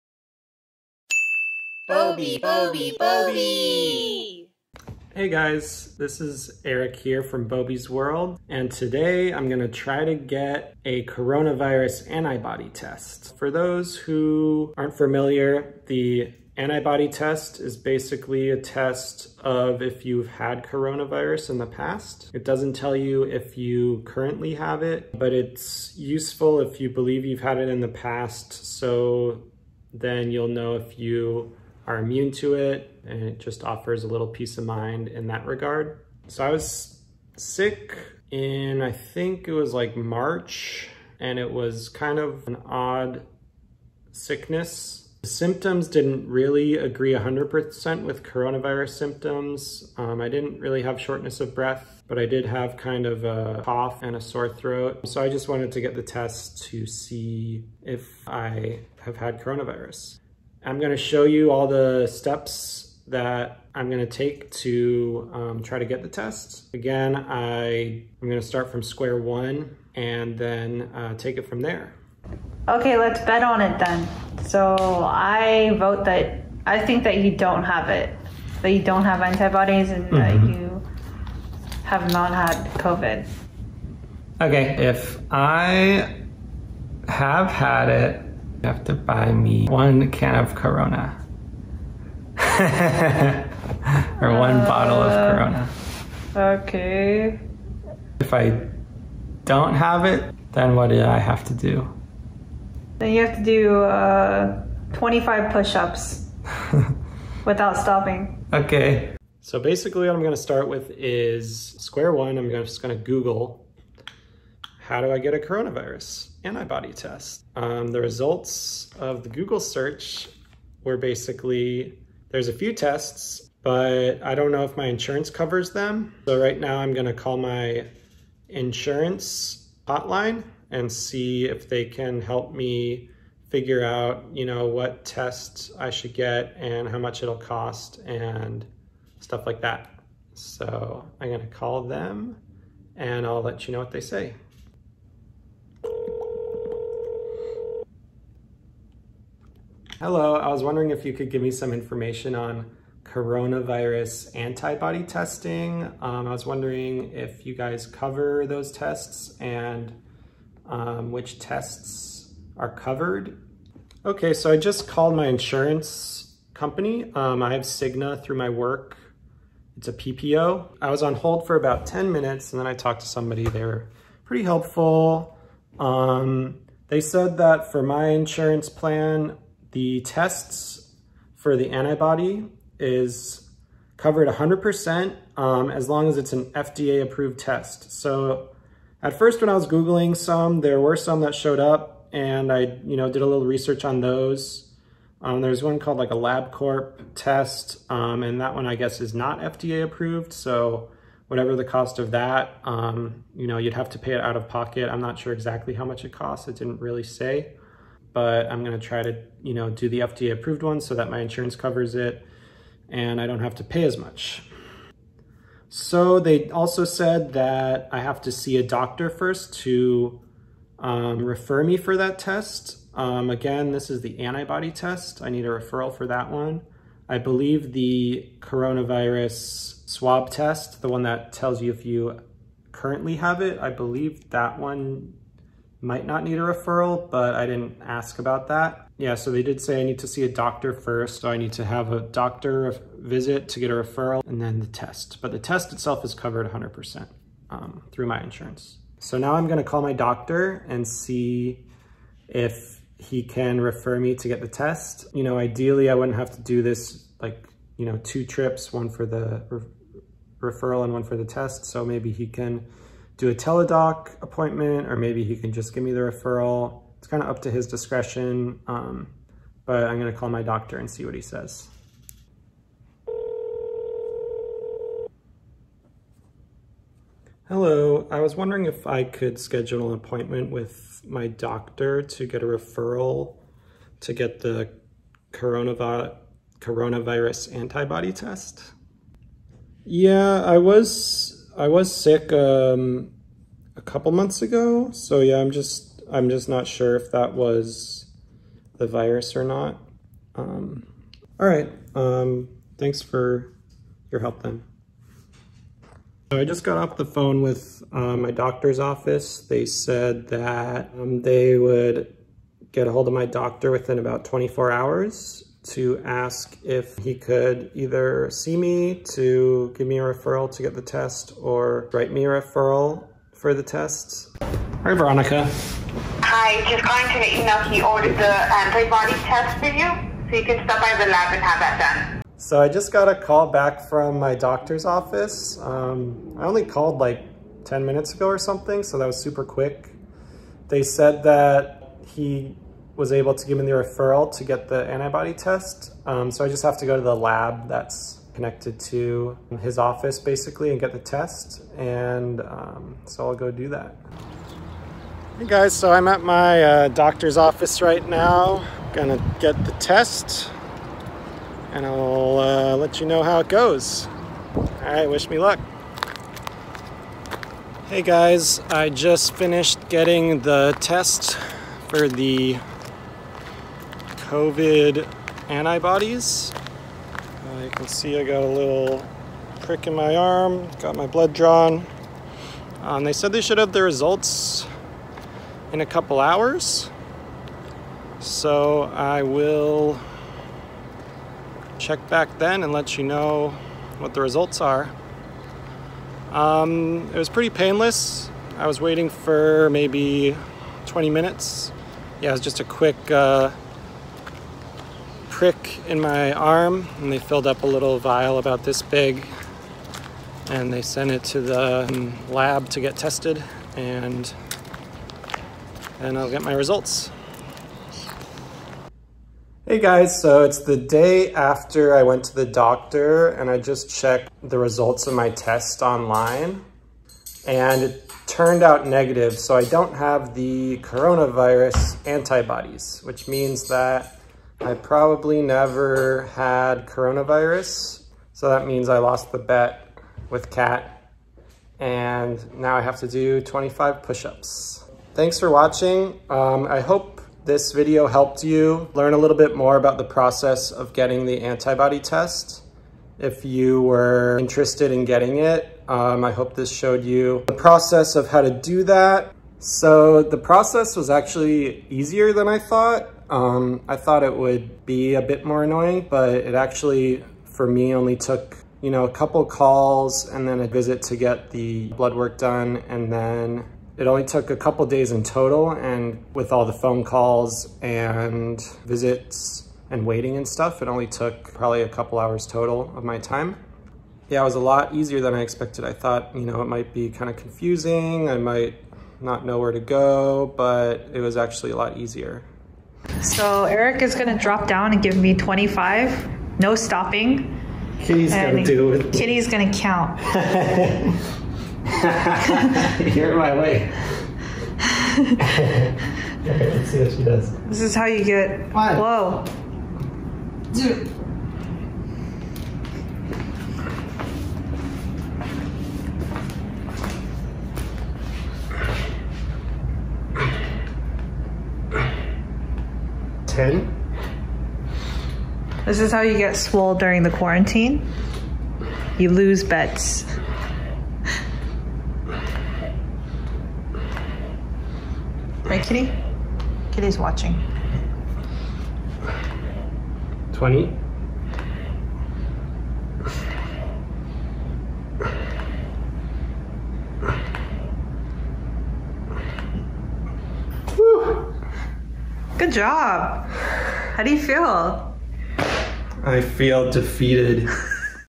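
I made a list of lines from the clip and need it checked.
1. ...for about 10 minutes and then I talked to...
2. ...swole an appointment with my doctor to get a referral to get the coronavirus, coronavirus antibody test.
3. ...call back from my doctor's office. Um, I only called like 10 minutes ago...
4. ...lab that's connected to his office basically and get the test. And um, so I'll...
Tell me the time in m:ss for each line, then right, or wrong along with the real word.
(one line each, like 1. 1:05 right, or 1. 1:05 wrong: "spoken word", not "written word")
1. 2:51 right
2. 4:39 wrong: "schedule", not "swole"
3. 5:33 right
4. 5:47 right.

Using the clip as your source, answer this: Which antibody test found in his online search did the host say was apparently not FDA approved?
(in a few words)
LabCorp.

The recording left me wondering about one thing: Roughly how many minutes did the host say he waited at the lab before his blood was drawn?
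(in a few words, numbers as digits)
20 minutes.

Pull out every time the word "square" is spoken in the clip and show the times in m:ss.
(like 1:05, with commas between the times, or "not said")
1:08, 1:51.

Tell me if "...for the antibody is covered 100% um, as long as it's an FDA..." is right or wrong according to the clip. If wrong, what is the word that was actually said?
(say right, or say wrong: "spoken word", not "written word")
right.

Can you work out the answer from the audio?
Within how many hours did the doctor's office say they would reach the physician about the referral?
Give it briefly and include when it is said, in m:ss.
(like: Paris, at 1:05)
24 hours, at 5:14.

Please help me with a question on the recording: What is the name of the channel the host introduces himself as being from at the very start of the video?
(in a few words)
Boby's World.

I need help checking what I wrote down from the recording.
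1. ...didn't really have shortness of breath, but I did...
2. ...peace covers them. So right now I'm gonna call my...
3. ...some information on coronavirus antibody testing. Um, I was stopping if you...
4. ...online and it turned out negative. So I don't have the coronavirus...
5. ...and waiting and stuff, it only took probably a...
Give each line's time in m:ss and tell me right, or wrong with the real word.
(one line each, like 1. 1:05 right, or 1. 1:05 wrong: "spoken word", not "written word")
1. 0:50 right
2. 2:04 wrong: "insurance", not "peace"
3. 2:31 wrong: "wondering", not "stopping"
4. 7:05 right
5. 7:59 right.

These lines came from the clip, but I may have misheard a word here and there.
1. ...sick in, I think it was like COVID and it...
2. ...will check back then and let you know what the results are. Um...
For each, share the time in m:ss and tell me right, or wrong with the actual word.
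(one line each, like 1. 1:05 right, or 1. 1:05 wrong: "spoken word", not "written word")
1. 0:37 wrong: "March", not "COVID"
2. 6:29 right.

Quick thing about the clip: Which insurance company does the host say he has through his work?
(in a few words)
Cigna.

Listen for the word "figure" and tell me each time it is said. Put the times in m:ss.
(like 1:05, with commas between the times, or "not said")
2:13.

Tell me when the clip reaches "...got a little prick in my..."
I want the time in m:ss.
6:18.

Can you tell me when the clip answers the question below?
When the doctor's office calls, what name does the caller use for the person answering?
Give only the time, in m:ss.
5:24.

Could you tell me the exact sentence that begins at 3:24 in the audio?
I'm not sure exactly how much it costs.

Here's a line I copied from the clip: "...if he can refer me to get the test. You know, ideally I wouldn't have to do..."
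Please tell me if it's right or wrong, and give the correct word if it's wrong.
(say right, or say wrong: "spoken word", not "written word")
right.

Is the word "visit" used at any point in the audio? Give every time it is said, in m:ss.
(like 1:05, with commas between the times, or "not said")
4:02, 7:50, 7:58.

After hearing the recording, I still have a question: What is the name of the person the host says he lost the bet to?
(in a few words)
Kat.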